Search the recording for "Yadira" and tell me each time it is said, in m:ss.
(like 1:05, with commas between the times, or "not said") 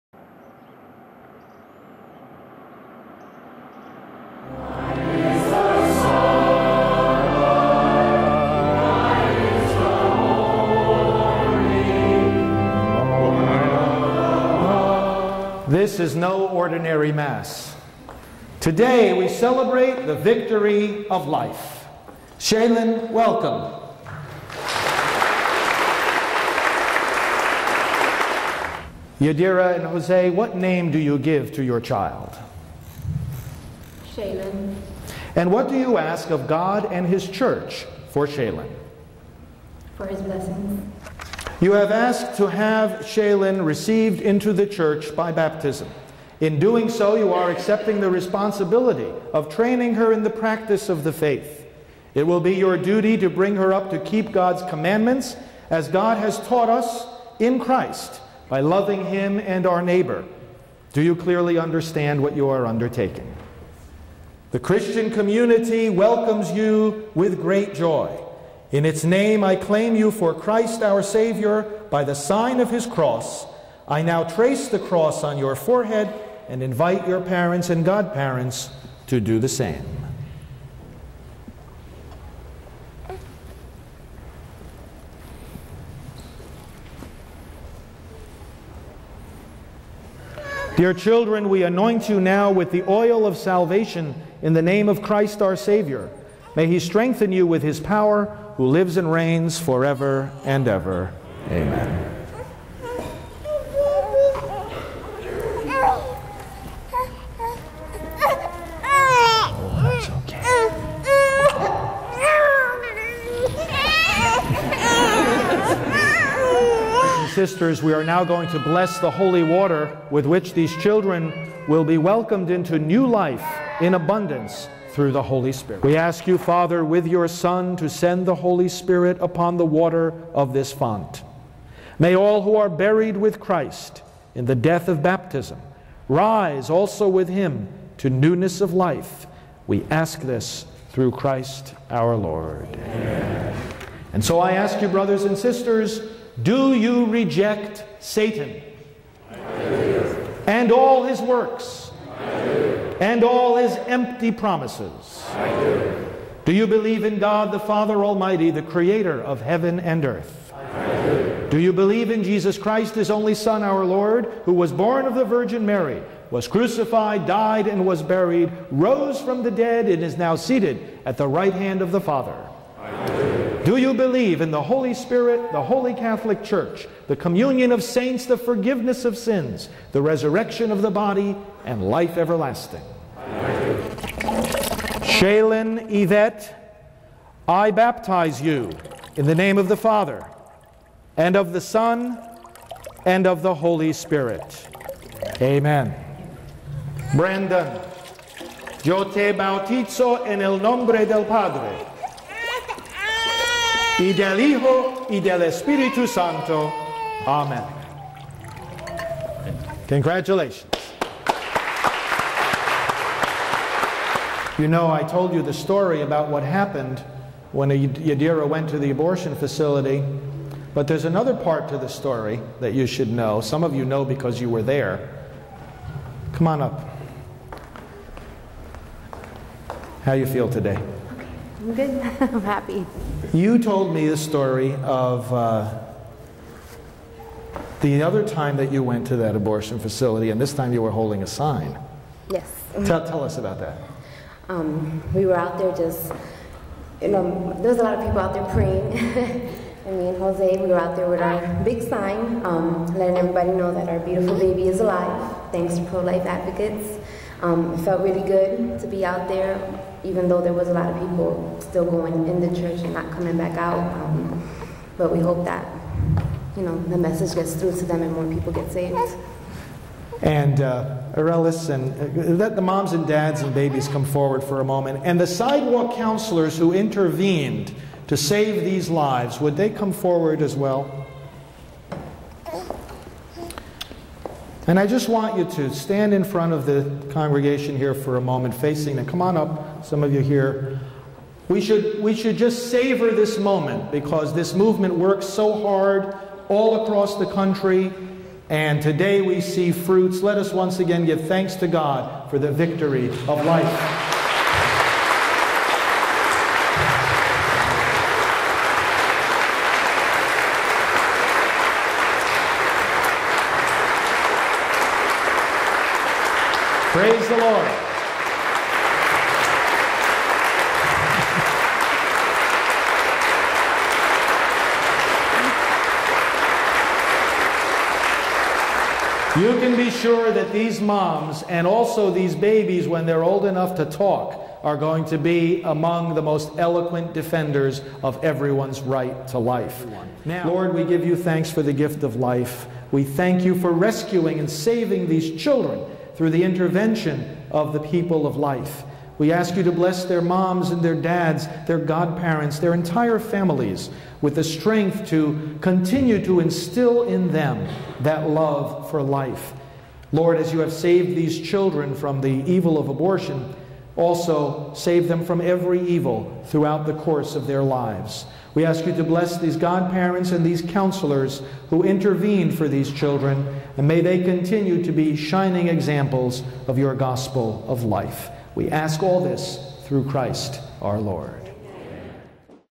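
0:29, 3:37.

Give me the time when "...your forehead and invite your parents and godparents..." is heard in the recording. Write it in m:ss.
1:15.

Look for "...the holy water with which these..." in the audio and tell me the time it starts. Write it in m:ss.
1:58.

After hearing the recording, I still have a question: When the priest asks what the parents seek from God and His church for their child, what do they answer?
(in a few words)
His blessings.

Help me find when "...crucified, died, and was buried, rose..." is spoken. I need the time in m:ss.
2:46.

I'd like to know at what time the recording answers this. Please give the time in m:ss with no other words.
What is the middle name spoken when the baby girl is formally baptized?
3:05.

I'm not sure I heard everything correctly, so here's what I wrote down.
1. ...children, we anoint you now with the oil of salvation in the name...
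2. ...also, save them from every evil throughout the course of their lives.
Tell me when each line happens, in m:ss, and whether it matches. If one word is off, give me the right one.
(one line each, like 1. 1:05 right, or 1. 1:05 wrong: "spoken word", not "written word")
1. 1:30 right
2. 6:03 right.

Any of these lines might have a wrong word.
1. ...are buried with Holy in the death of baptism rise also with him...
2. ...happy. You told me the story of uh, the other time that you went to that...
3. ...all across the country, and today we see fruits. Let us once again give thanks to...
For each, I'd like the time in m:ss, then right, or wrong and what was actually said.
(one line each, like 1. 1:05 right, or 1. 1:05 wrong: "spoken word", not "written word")
1. 2:12 wrong: "Christ", not "Holy"
2. 3:52 right
3. 4:56 right.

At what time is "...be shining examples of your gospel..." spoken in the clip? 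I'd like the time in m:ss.
6:14.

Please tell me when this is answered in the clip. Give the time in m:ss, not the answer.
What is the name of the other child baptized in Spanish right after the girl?
3:17.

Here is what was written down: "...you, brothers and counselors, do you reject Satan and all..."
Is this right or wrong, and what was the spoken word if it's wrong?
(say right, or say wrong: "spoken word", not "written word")
wrong: "sisters", not "counselors".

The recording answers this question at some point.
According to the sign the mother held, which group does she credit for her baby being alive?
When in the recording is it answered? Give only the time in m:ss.
4:15.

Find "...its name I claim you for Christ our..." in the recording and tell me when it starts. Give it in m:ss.
1:08.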